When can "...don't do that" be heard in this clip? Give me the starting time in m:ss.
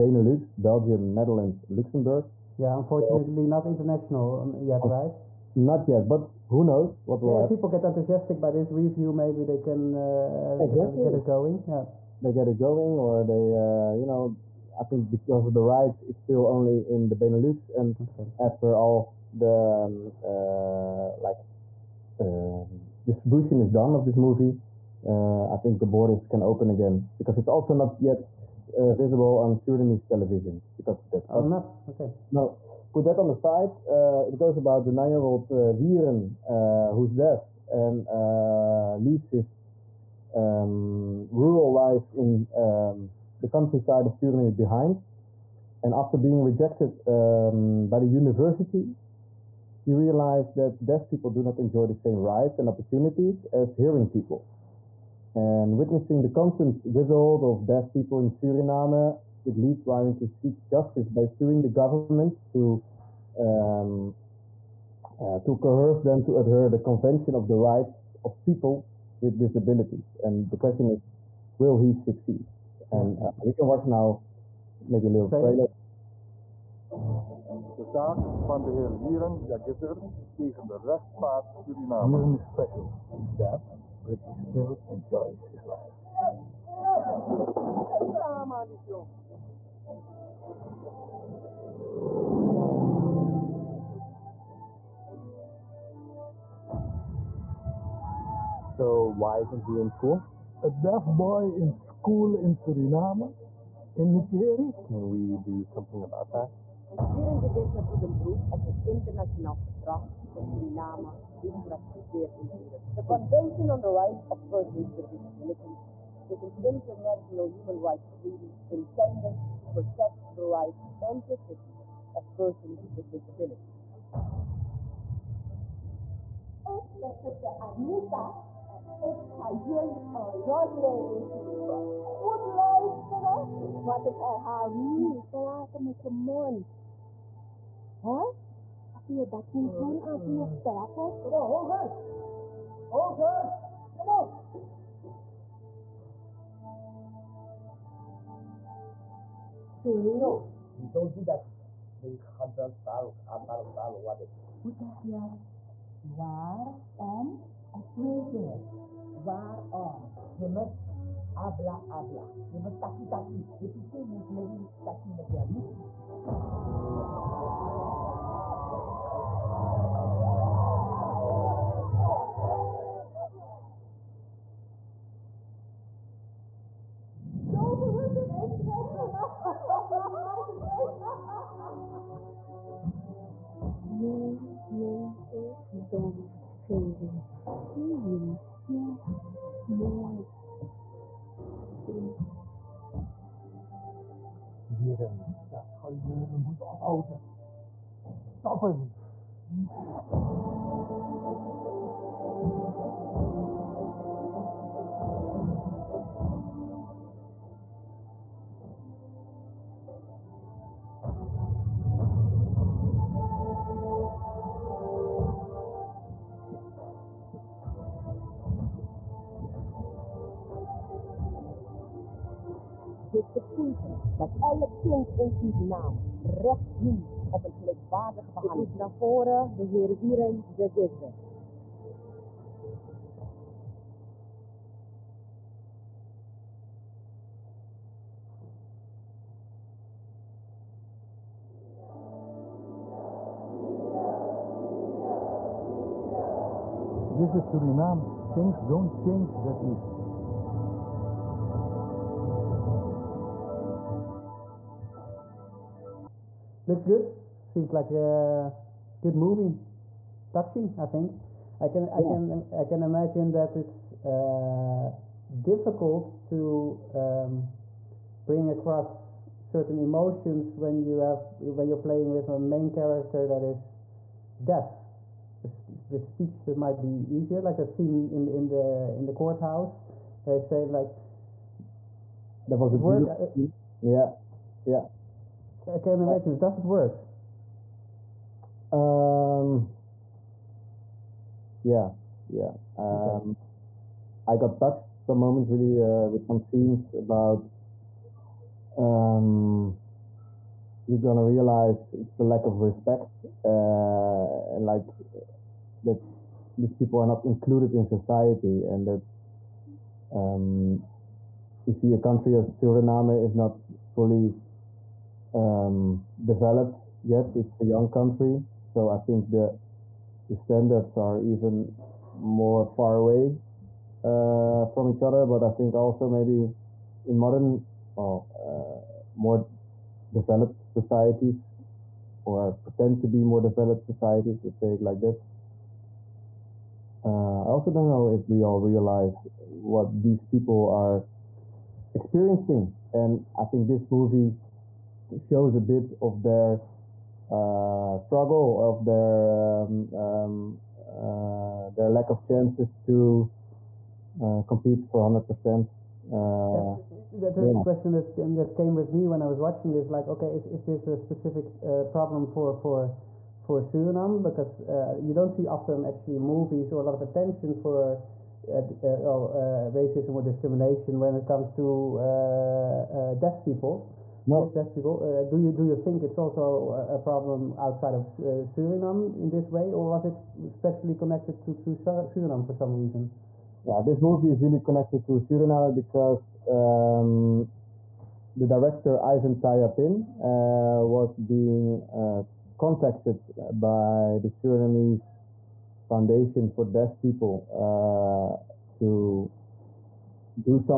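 2:30.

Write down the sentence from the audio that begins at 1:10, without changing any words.
And the question is, will he succeed?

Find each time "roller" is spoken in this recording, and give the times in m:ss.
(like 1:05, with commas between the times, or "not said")
not said.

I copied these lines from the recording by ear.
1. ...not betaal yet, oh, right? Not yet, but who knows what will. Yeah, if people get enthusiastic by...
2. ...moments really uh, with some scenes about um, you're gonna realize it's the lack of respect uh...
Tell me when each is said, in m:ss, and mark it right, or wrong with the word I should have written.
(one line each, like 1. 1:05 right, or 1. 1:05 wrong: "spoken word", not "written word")
1. 0:03 wrong: "international", not "betaal"
2. 4:55 right.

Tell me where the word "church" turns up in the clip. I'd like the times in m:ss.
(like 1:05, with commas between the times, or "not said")
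not said.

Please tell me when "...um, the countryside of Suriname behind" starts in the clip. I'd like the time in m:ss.
0:42.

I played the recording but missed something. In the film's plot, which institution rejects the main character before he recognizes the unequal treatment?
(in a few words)
The university.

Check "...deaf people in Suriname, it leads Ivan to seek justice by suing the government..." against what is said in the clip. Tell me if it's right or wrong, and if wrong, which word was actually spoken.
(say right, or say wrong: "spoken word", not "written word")
wrong: "Ryan", not "Ivan".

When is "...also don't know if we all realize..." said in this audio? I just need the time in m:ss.
5:37.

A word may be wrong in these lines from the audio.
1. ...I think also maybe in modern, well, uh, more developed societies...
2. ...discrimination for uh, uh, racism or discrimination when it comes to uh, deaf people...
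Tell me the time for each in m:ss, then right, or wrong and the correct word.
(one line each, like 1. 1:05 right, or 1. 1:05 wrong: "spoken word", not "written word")
1. 5:25 right
2. 6:07 wrong: "attention", not "discrimination".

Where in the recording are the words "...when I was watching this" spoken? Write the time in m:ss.
5:59.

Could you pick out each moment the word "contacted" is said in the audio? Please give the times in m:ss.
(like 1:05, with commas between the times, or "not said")
6:32.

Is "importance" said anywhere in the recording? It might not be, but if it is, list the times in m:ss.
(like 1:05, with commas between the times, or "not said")
not said.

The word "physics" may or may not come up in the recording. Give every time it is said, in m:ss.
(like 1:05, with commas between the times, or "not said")
not said.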